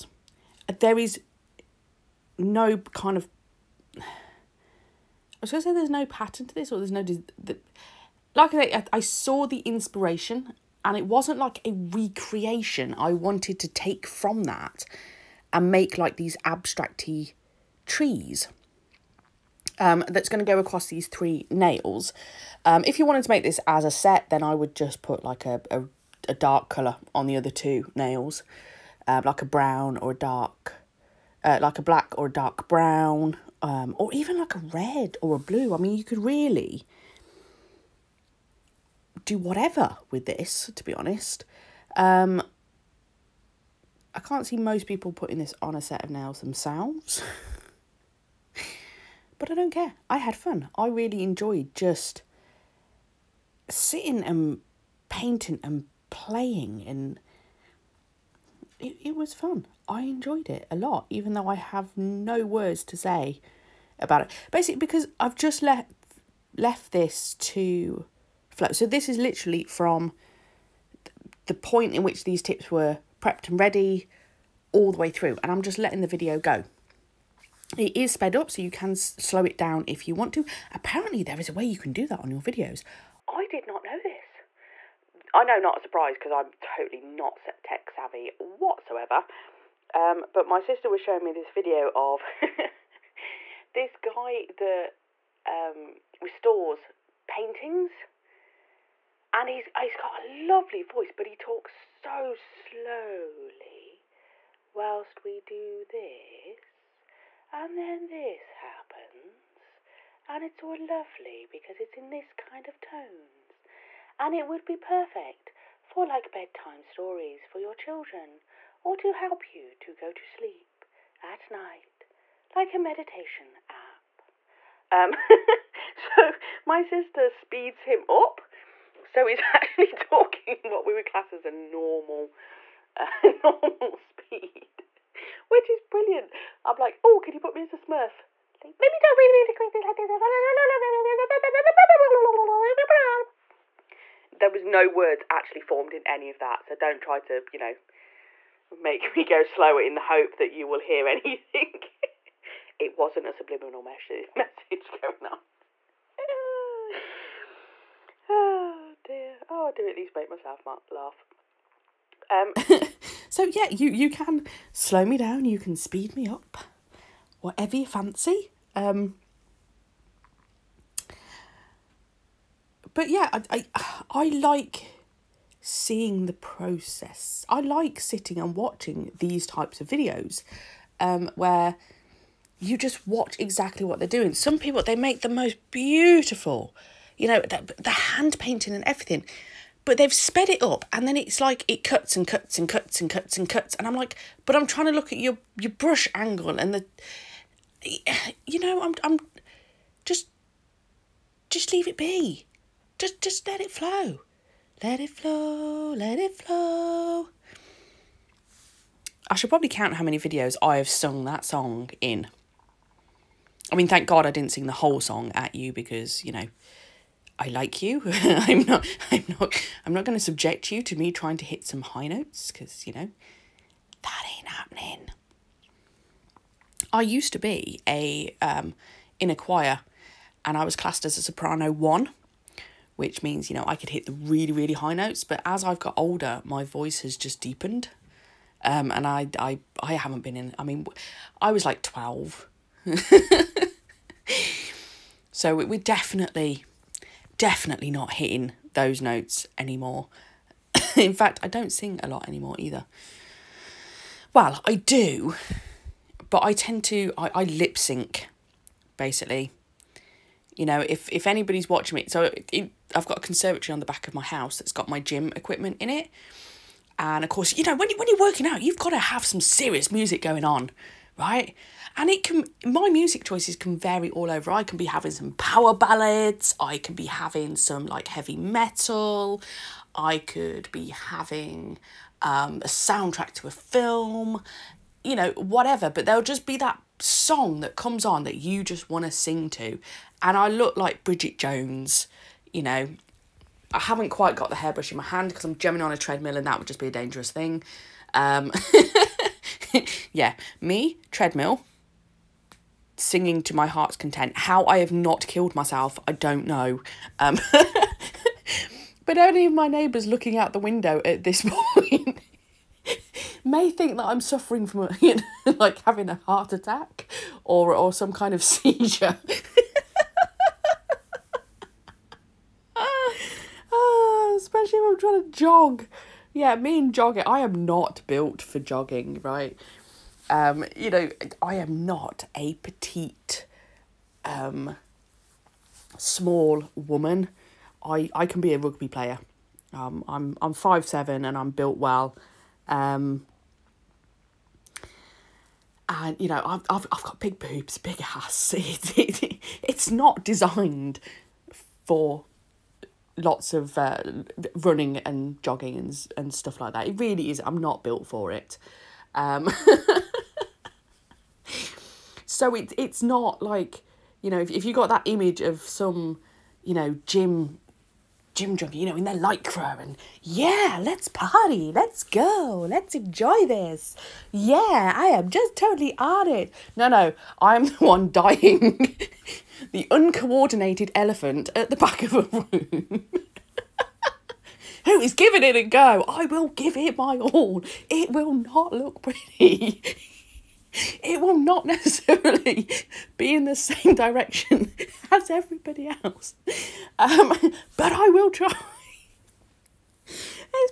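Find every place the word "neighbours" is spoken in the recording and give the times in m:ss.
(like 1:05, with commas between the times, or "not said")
5:09.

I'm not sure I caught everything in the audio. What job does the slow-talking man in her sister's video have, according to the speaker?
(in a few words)
restores paintings.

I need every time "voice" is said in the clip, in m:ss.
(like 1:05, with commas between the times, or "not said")
1:40, 3:56.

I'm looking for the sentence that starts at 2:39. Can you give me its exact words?
Oh, I do at least make myself laugh.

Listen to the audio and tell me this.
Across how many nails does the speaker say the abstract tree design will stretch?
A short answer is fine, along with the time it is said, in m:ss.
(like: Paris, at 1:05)
3, at 0:21.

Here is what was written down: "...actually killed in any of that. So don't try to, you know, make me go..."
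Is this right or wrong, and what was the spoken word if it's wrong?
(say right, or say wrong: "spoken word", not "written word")
wrong: "formed", not "killed".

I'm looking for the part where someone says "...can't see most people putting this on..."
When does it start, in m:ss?
0:44.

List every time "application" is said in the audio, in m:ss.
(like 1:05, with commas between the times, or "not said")
not said.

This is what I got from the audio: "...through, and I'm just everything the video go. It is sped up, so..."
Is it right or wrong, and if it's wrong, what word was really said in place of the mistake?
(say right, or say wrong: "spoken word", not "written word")
wrong: "letting", not "everything".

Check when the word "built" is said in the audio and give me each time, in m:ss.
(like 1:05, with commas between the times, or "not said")
5:28, 5:41, 5:57.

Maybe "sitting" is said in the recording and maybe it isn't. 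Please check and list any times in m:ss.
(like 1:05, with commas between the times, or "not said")
0:53, 2:58.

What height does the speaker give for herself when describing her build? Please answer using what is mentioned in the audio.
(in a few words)
5'7".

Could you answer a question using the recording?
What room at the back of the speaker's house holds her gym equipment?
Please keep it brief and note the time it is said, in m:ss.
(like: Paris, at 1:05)
conservatory, at 4:23.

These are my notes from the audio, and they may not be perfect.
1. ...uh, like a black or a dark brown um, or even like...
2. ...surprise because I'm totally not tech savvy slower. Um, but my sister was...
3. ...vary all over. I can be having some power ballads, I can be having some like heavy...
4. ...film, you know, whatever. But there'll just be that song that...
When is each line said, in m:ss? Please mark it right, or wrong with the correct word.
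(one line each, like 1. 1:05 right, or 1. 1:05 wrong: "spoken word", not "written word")
1. 0:31 right
2. 1:25 wrong: "whatsoever", not "slower"
3. 4:33 right
4. 4:43 right.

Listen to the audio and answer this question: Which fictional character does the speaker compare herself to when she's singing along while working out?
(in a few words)
Bridget Jones.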